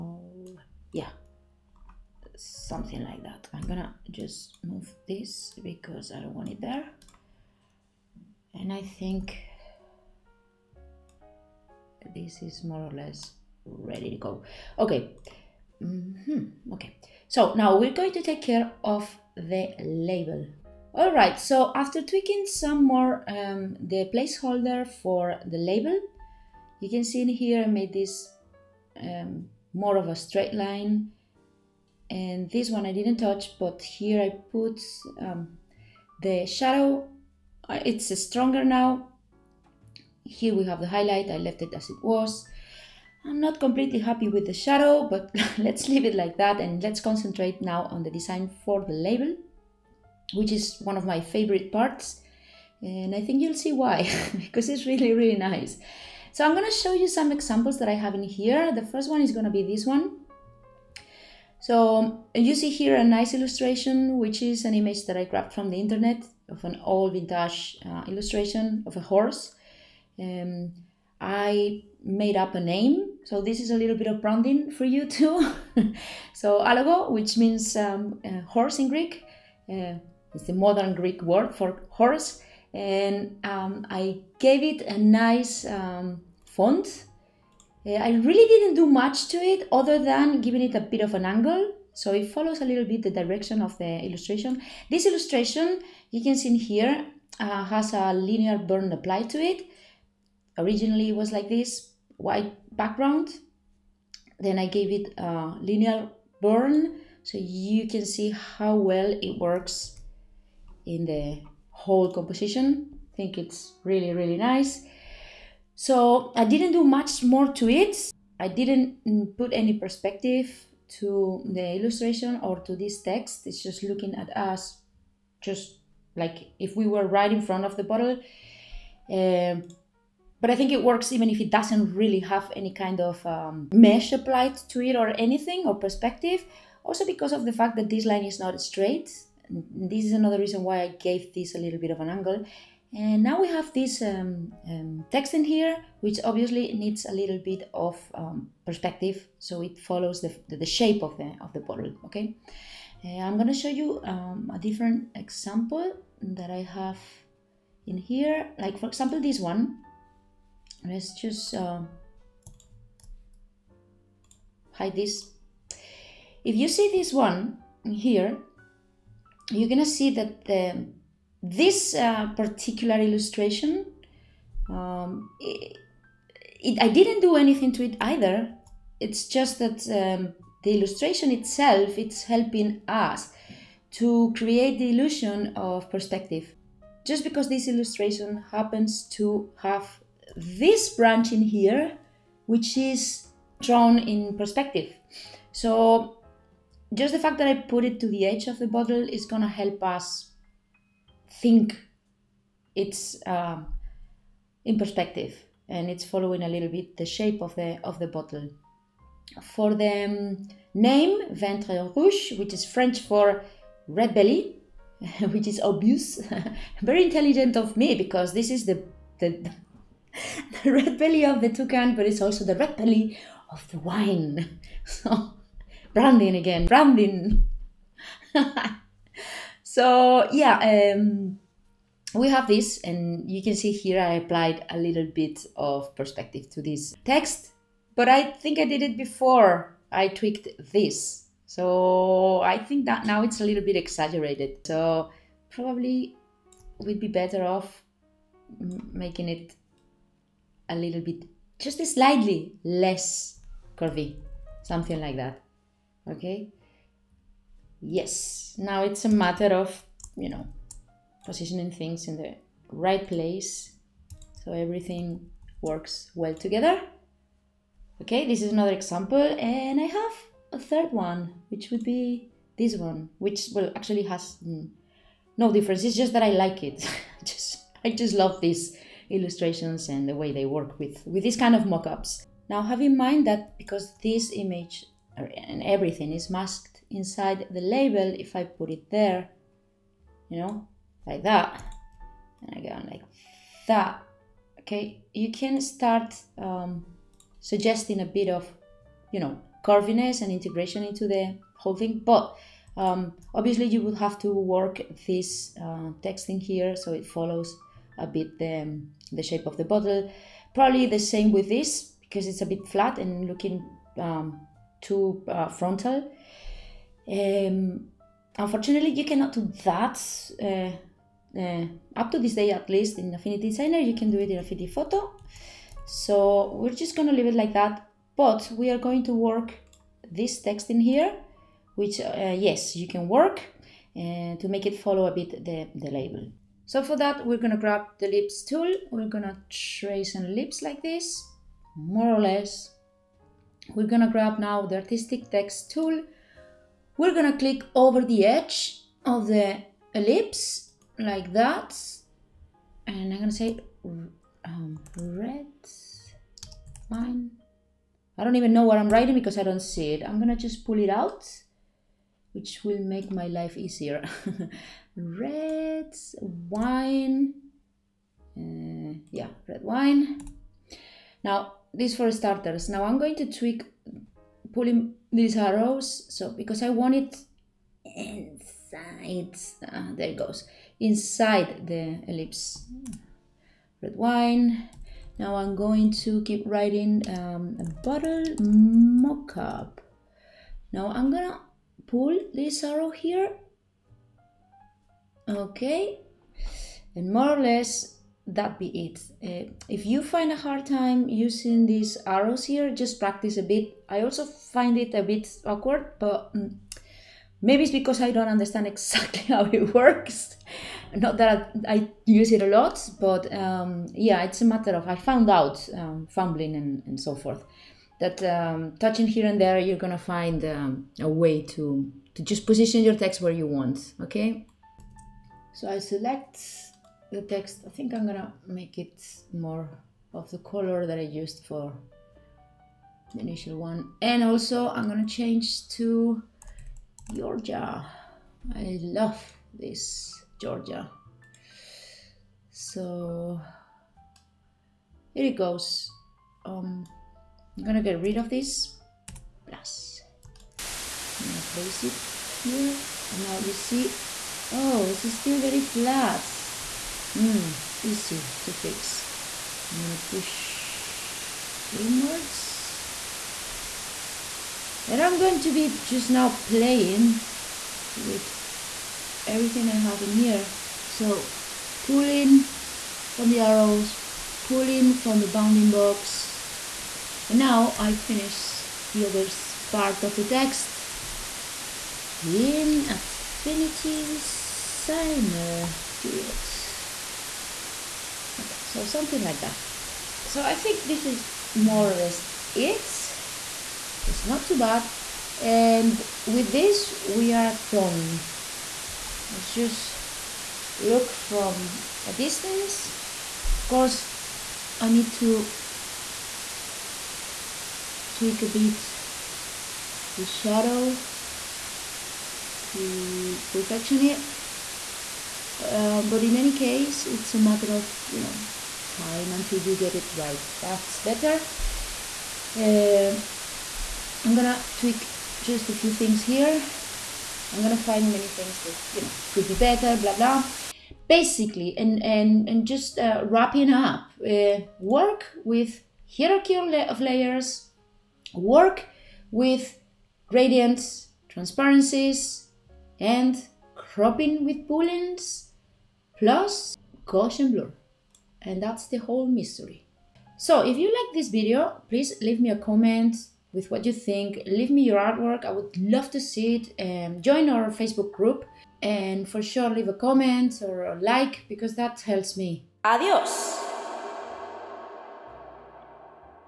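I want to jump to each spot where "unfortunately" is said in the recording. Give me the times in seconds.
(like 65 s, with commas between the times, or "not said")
318 s.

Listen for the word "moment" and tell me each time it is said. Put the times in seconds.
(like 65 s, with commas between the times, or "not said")
not said.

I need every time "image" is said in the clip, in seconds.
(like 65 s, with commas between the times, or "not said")
64 s, 284 s.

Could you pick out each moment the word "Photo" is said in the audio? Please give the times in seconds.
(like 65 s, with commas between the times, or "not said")
324 s.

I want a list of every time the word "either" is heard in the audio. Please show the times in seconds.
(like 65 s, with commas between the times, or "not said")
177 s.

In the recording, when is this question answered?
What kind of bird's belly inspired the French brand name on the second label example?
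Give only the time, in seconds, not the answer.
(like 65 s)
221 s.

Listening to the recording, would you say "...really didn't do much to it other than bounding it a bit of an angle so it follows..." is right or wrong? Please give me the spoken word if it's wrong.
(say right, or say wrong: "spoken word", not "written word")
wrong: "giving", not "bounding".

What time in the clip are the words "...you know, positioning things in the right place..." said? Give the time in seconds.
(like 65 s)
260 s.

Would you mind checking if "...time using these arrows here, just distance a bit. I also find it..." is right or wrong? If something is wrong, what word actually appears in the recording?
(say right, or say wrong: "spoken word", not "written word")
wrong: "practice", not "distance".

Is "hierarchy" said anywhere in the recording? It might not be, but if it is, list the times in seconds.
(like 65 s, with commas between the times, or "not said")
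536 s.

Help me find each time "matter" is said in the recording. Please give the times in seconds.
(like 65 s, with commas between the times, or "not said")
259 s, 414 s, 517 s.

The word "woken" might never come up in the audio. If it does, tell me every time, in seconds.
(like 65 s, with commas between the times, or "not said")
not said.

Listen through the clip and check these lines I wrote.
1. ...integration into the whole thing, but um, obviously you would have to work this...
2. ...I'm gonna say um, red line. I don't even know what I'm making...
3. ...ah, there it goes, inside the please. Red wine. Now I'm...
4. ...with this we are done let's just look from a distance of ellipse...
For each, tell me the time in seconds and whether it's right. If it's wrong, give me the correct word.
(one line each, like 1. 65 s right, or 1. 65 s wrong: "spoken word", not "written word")
1. 300 s right
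2. 353 s wrong: "writing", not "making"
3. 379 s wrong: "ellipse", not "please"
4. 496 s wrong: "course", not "ellipse".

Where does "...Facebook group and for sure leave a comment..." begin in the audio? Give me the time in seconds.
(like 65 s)
557 s.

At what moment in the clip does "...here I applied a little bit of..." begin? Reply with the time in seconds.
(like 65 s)
233 s.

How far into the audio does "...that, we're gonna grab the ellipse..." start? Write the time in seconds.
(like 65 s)
336 s.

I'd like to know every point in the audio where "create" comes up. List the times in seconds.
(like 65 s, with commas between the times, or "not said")
184 s.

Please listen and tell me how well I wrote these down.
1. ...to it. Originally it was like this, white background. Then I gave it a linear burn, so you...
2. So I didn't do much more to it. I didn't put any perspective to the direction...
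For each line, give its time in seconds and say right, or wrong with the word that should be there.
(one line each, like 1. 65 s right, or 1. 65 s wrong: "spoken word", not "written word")
1. 99 s right
2. 115 s wrong: "illustration", not "direction".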